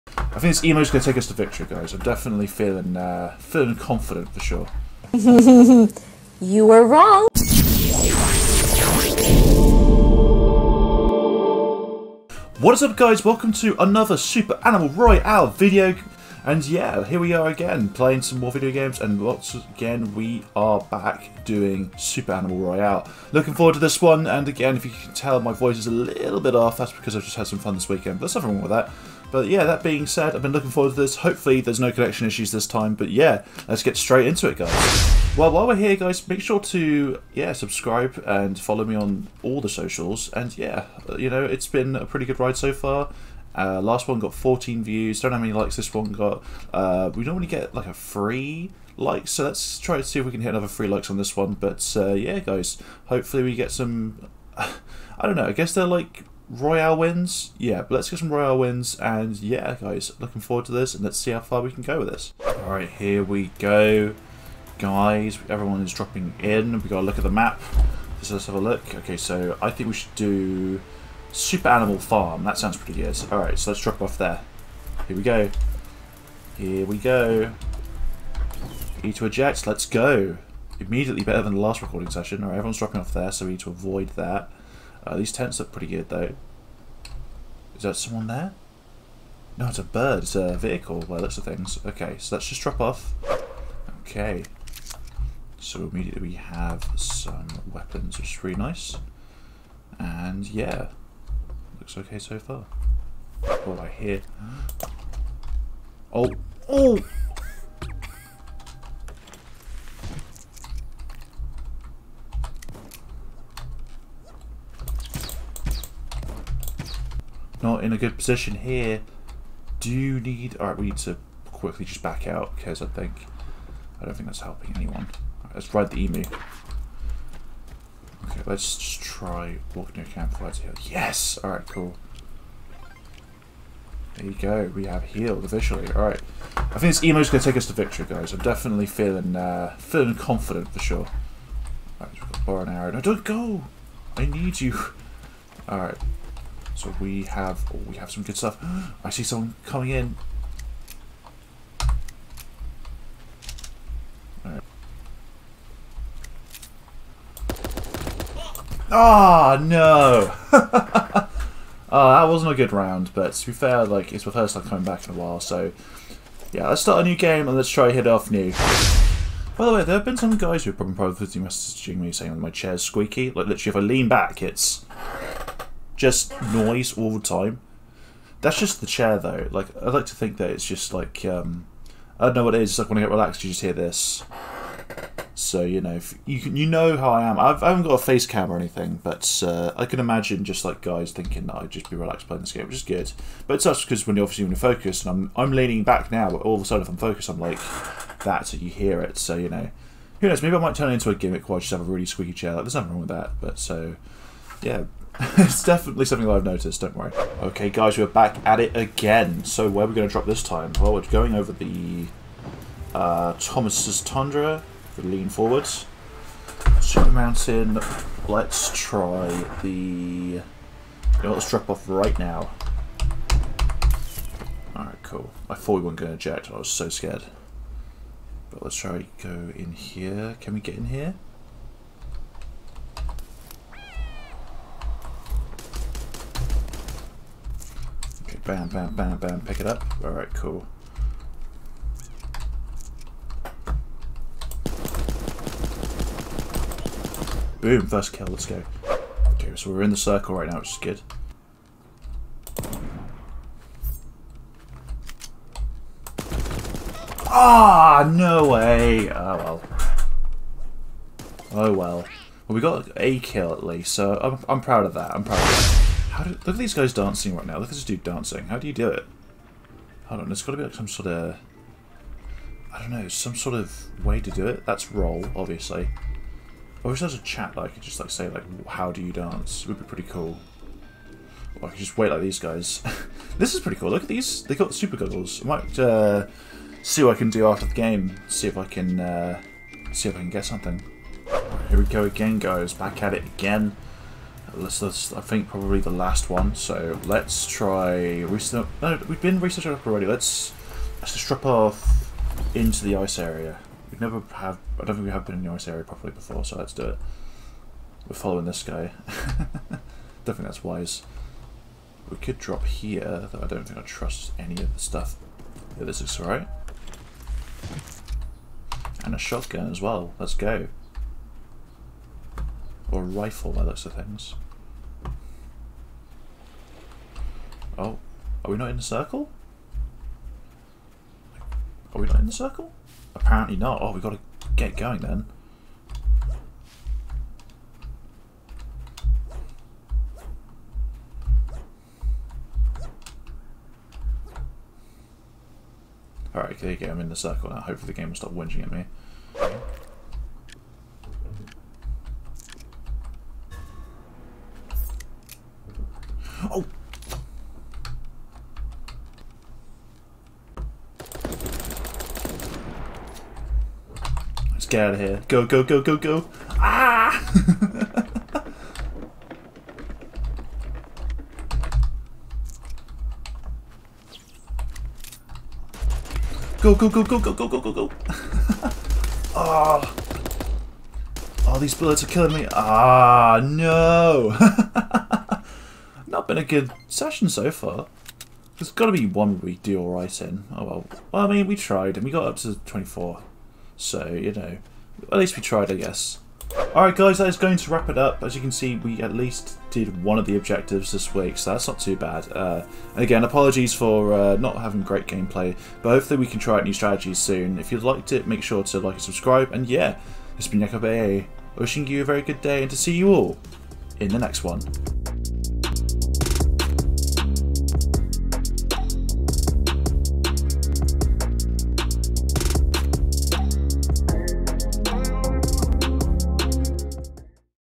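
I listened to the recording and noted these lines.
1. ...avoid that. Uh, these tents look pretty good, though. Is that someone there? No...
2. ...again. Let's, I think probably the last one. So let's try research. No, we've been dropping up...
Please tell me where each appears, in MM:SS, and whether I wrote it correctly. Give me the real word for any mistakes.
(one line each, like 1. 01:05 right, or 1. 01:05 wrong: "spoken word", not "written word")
1. 01:23 right
2. 04:53 wrong: "researching", not "dropping".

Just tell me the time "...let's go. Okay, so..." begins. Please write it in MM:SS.
04:08.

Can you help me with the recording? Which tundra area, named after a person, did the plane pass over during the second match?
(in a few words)
Thomas's Tundra.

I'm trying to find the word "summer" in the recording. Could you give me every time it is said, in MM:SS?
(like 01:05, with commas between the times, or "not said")
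not said.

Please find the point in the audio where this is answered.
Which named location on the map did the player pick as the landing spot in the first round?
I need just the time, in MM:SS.
01:11.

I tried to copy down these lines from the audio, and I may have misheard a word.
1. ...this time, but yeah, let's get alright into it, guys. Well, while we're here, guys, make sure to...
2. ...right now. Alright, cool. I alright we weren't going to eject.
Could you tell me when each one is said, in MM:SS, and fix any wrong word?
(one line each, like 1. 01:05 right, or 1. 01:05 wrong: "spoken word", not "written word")
1. 00:32 wrong: "straight", not "alright"
2. 03:41 wrong: "thought", not "alright".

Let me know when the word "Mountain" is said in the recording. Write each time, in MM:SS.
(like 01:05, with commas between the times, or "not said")
03:37.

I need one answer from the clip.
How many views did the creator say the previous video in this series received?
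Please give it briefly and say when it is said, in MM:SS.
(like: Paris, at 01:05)
14, at 00:44.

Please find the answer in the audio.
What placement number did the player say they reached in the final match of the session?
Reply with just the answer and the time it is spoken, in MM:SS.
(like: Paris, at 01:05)
24, at 06:32.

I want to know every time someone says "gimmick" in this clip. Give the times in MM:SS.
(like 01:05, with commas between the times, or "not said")
03:21.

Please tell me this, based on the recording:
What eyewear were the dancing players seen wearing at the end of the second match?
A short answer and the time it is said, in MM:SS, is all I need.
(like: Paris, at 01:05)
Super goggles, at 04:44.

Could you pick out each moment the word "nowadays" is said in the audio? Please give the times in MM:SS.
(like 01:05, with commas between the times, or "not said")
not said.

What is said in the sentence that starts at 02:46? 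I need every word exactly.
Yeah, let's start a new game and let's try hit off new.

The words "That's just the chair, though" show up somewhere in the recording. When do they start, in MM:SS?
02:58.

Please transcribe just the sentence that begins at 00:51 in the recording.
But uh, yeah, guys, hopefully we get some.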